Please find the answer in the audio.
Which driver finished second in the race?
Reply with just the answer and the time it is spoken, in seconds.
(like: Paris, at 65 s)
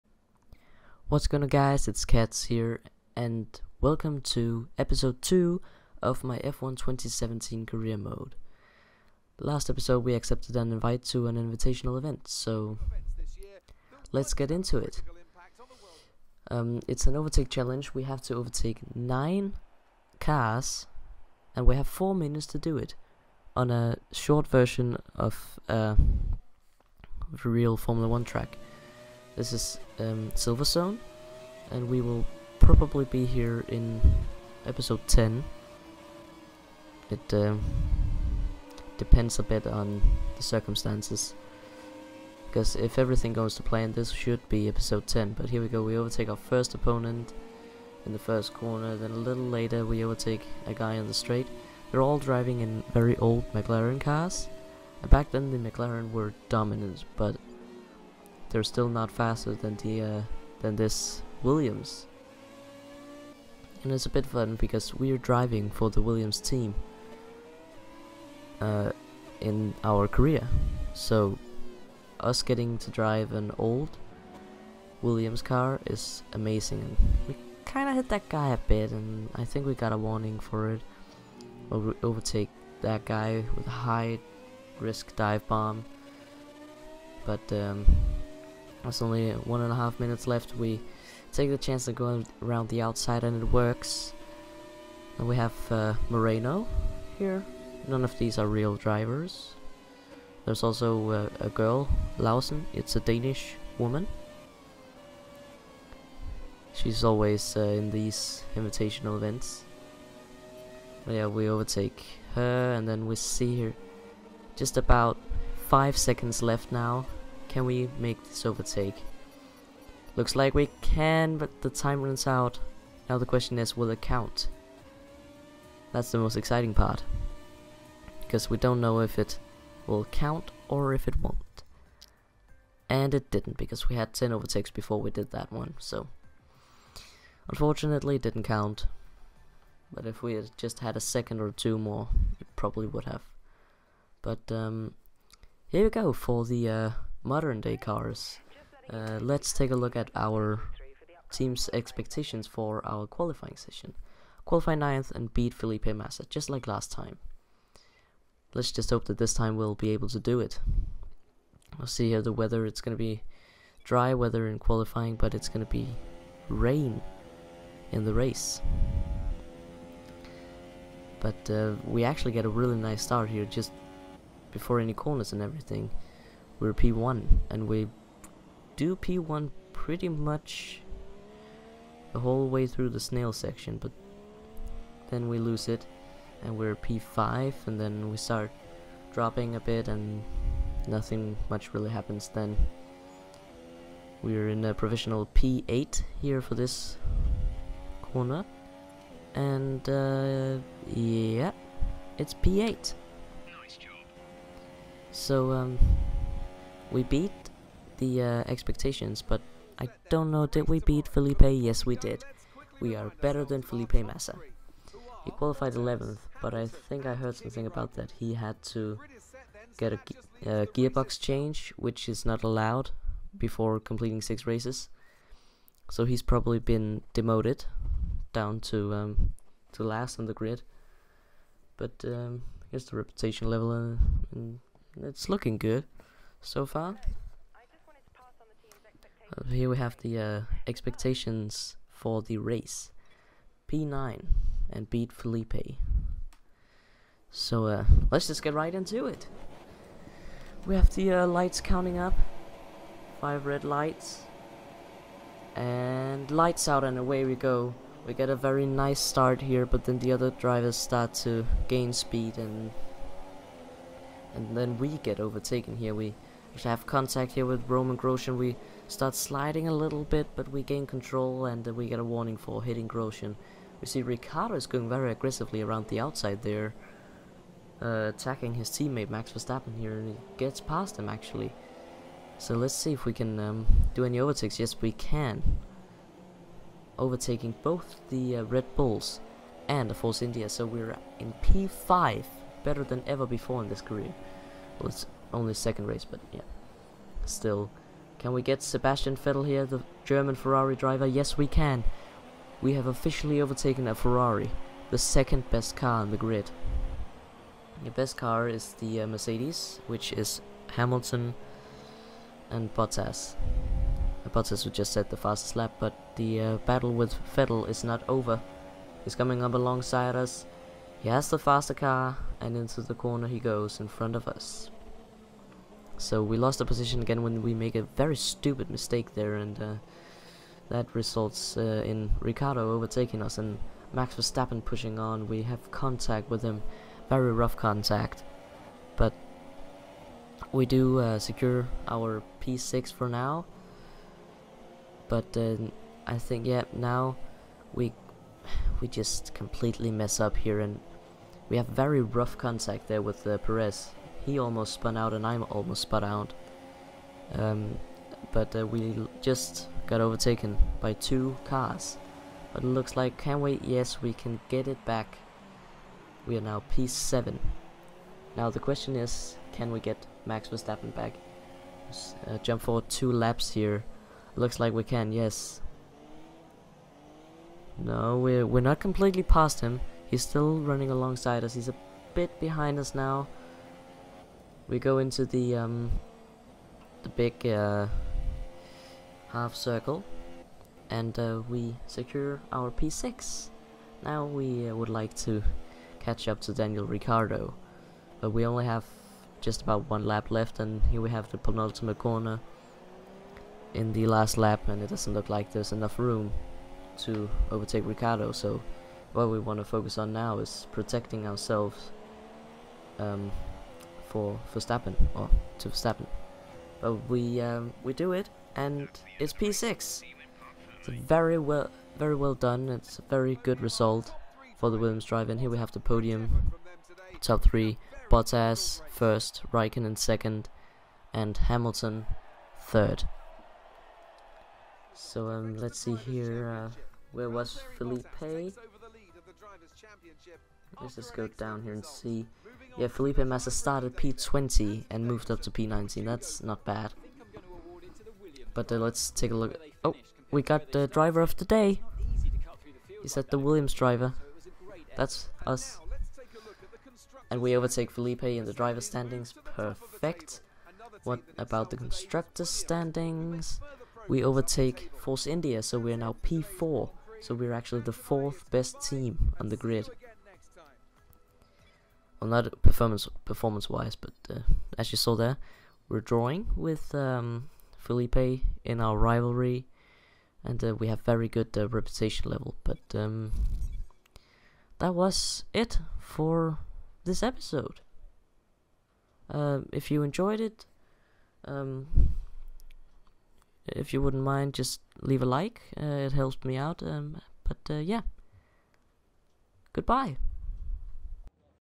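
Raikkonen, at 429 s.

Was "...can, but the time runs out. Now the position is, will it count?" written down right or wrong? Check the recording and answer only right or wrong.
wrong.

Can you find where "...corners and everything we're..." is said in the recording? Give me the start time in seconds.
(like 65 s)
174 s.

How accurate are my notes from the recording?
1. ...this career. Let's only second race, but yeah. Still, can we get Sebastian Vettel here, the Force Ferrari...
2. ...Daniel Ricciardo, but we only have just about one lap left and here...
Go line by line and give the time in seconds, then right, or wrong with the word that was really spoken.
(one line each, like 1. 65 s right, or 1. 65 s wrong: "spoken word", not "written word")
1. 293 s wrong: "German", not "Force"
2. 396 s right.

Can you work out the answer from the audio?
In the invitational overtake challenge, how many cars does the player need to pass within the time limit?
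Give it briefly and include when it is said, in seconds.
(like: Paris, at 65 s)
9, at 18 s.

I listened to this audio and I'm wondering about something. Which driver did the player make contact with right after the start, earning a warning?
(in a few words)
Romain Grosjean.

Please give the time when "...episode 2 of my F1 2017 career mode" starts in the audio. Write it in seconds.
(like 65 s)
4 s.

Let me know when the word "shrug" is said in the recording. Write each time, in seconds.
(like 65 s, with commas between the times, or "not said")
not said.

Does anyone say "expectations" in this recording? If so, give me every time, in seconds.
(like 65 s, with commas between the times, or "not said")
151 s, 208 s, 240 s.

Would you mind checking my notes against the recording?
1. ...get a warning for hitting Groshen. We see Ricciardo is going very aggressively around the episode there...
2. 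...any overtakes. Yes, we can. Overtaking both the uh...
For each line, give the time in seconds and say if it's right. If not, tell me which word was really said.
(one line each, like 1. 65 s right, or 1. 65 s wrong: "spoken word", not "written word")
1. 271 s wrong: "outside", not "episode"
2. 284 s right.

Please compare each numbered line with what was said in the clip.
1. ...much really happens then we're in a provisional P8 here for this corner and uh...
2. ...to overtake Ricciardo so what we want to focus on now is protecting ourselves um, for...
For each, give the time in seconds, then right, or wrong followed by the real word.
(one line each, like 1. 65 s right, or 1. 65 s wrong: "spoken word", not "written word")
1. 191 s right
2. 406 s right.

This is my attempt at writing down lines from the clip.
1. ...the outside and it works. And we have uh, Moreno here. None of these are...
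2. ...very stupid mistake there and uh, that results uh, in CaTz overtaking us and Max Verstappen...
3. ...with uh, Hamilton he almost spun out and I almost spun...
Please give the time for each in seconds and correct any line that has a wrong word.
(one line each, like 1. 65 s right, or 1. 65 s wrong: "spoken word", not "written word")
1. 92 s right
2. 327 s wrong: "Ricciardo", not "CaTz"
3. 353 s wrong: "Perez", not "Hamilton".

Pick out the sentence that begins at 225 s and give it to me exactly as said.
So he's probably been demoted down to um, to last on the grid.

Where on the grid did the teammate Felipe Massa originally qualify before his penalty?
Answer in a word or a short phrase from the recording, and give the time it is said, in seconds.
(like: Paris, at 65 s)
11th, at 215 s.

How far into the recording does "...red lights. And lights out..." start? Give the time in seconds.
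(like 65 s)
253 s.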